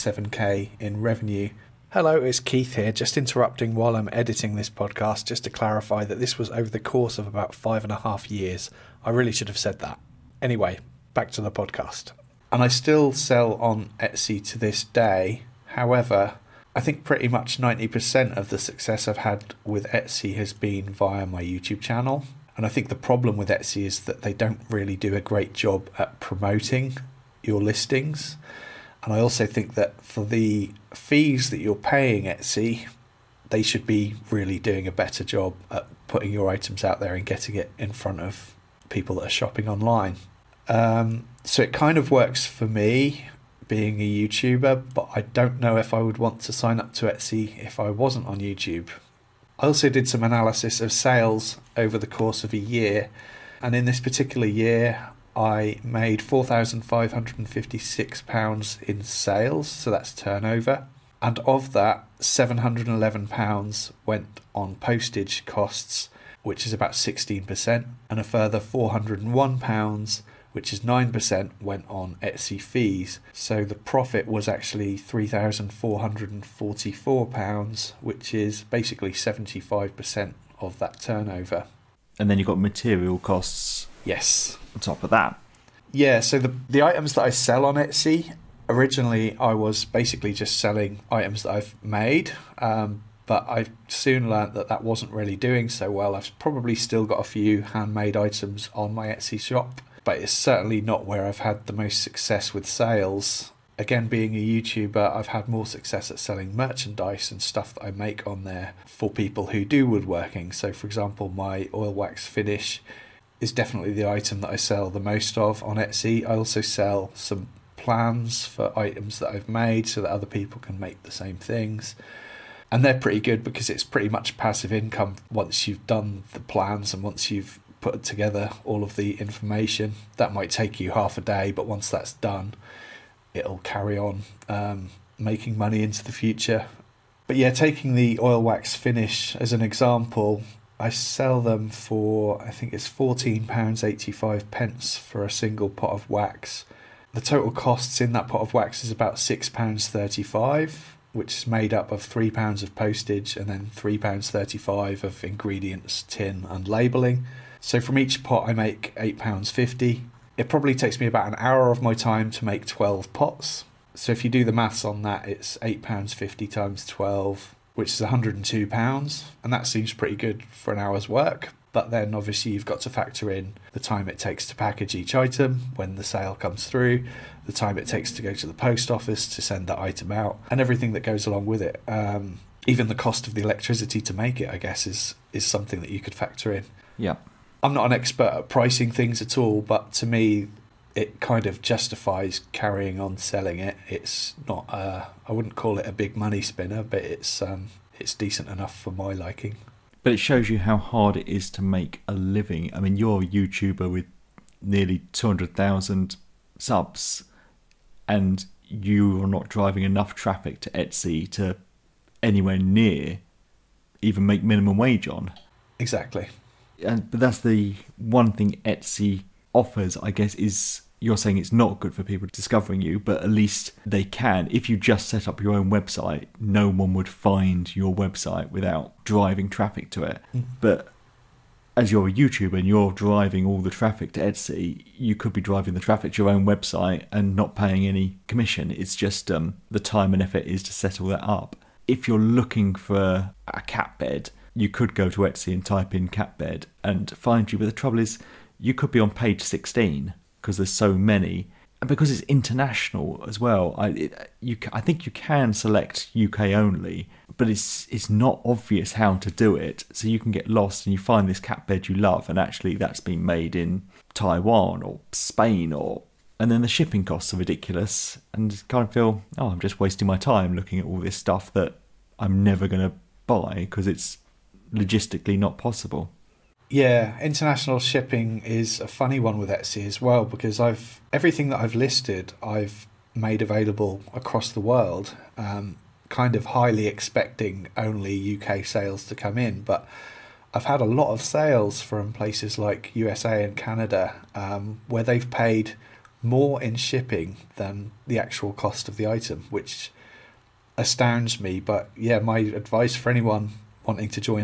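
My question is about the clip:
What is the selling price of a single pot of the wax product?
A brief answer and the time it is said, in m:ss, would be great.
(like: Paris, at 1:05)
£14.85, at 2:22.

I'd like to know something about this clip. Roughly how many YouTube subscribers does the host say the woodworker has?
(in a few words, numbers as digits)
nearly 200,000.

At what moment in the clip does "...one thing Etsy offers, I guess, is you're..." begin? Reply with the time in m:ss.
3:37.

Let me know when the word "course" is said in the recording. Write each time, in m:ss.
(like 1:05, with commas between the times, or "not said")
0:06, 0:52.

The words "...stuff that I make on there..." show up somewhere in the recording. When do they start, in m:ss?
1:47.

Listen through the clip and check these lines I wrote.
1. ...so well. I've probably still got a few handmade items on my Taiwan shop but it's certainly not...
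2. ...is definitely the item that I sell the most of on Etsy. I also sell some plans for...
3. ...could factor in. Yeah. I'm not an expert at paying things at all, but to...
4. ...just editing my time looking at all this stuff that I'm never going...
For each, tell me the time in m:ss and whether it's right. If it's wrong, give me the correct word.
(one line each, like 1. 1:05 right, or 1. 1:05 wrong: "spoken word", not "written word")
1. 1:35 wrong: "Etsy", not "Taiwan"
2. 1:53 right
3. 3:05 wrong: "pricing", not "paying"
4. 4:29 wrong: "wasting", not "editing".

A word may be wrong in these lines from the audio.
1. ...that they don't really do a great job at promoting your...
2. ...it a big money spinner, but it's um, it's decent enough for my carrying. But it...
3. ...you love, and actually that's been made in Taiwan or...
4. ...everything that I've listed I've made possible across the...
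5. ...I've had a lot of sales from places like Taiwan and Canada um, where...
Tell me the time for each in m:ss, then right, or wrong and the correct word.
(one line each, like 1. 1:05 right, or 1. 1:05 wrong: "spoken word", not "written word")
1. 0:24 right
2. 3:15 wrong: "liking", not "carrying"
3. 4:21 right
4. 4:41 wrong: "available", not "possible"
5. 4:50 wrong: "USA", not "Taiwan".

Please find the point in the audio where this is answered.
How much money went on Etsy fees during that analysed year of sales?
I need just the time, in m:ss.
1:08.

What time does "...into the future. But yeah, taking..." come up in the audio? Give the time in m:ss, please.
2:15.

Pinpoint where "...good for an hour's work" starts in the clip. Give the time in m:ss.
2:50.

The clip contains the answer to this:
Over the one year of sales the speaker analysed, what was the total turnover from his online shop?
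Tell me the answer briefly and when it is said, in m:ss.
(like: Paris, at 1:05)
£4,556, at 0:56.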